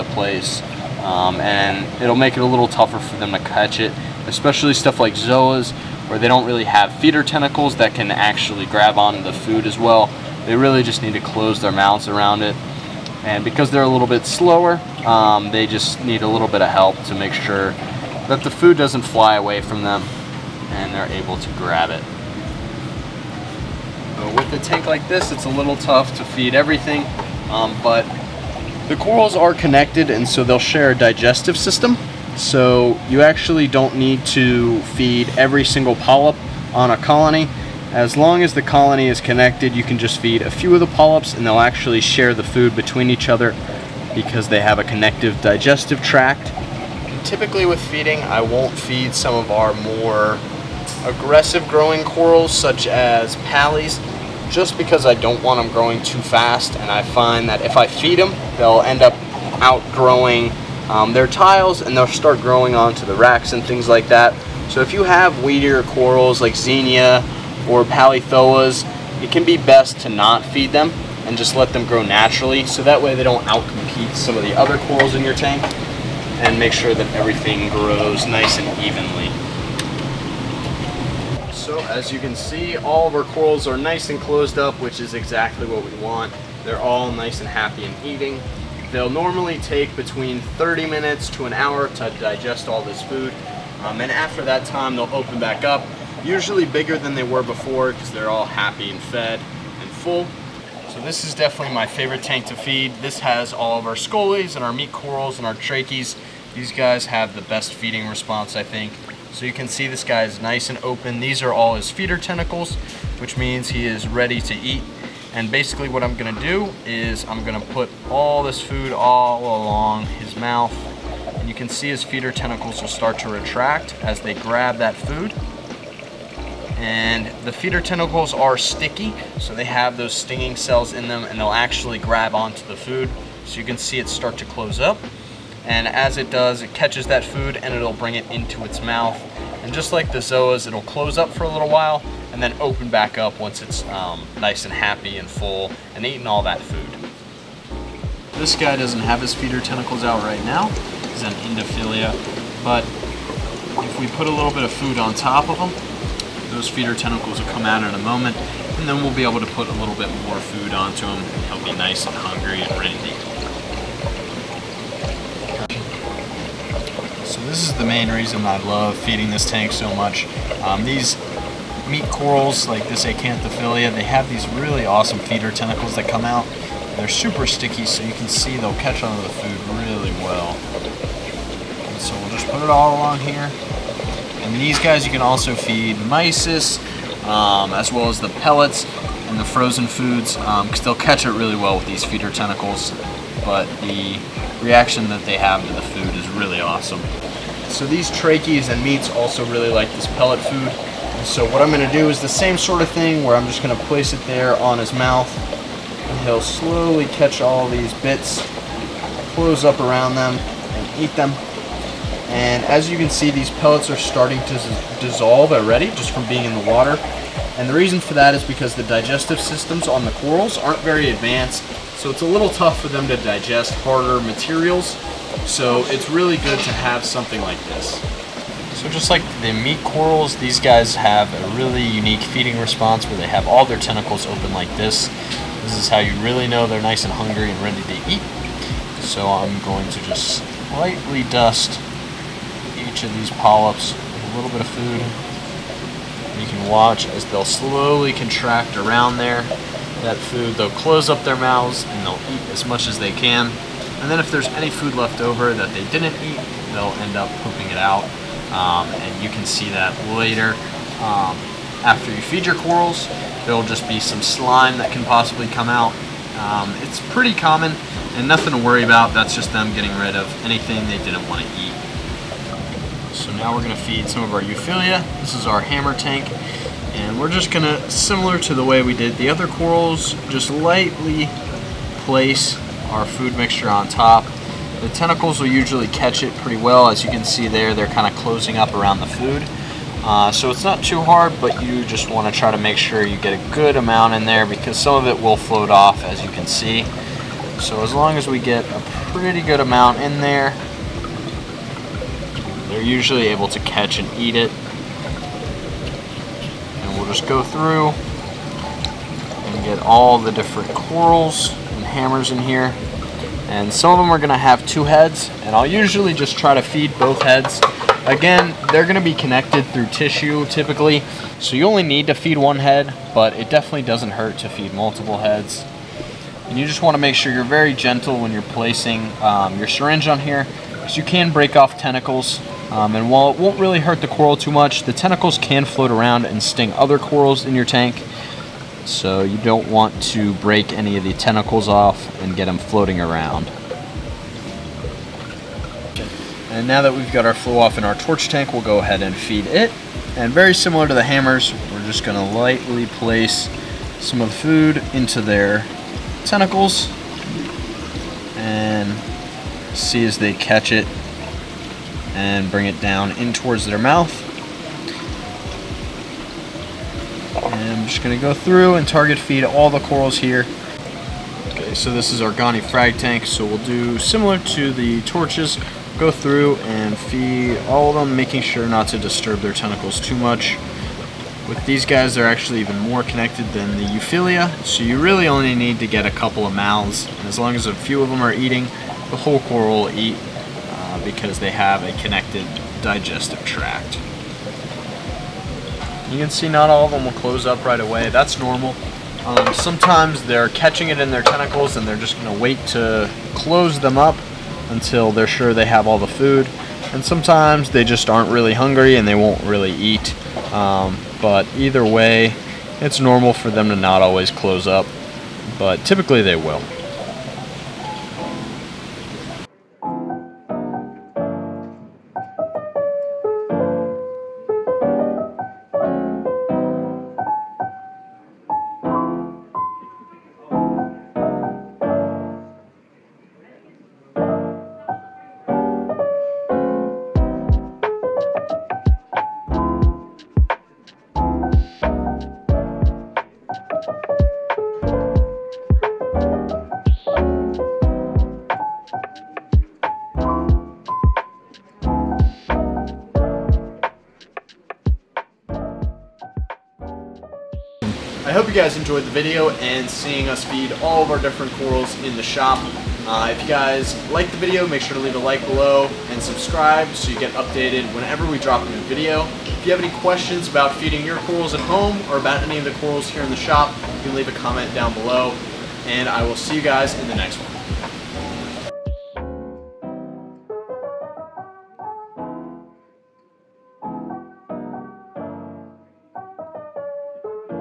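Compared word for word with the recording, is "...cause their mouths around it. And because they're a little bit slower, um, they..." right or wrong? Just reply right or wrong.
wrong.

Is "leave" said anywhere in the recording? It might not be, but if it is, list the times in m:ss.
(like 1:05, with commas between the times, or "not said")
7:45, 7:54.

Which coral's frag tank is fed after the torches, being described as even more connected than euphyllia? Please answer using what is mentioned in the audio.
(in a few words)
Goni.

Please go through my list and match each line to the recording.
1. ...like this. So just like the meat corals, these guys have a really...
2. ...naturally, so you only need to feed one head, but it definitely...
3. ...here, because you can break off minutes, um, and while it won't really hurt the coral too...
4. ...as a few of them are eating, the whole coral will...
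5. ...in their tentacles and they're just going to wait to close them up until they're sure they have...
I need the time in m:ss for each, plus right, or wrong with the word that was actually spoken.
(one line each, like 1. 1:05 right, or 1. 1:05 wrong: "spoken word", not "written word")
1. 3:47 right
2. 5:20 wrong: "typically", not "naturally"
3. 5:30 wrong: "tentacles", not "minutes"
4. 6:27 right
5. 6:41 right.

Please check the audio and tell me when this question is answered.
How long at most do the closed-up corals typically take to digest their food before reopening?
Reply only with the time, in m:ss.
1:31.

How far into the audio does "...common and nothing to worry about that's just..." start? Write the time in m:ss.
4:27.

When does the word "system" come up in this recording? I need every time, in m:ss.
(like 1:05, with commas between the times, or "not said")
0:31, 3:39.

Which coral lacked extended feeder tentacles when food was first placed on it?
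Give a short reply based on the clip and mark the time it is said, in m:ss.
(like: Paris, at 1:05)
Endophilia, at 2:31.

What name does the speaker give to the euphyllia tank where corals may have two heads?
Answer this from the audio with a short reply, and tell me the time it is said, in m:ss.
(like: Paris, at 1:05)
Hammer tank, at 4:35.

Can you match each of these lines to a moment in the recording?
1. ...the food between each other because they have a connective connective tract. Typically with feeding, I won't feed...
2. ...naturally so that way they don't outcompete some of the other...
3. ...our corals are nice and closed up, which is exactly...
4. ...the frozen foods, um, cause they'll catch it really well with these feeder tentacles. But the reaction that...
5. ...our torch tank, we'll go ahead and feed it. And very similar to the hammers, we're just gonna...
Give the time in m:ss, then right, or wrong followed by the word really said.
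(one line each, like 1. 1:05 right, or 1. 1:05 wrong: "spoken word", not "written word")
1. 0:42 wrong: "digestive", not "connective"
2. 1:12 right
3. 1:23 right
4. 3:09 right
5. 5:47 right.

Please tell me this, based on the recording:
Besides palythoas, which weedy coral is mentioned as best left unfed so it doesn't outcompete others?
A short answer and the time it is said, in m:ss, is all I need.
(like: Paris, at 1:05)
Xenia, at 1:06.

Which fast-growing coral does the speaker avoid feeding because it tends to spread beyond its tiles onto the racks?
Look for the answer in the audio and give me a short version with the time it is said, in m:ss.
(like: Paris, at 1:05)
Pallies, at 0:53.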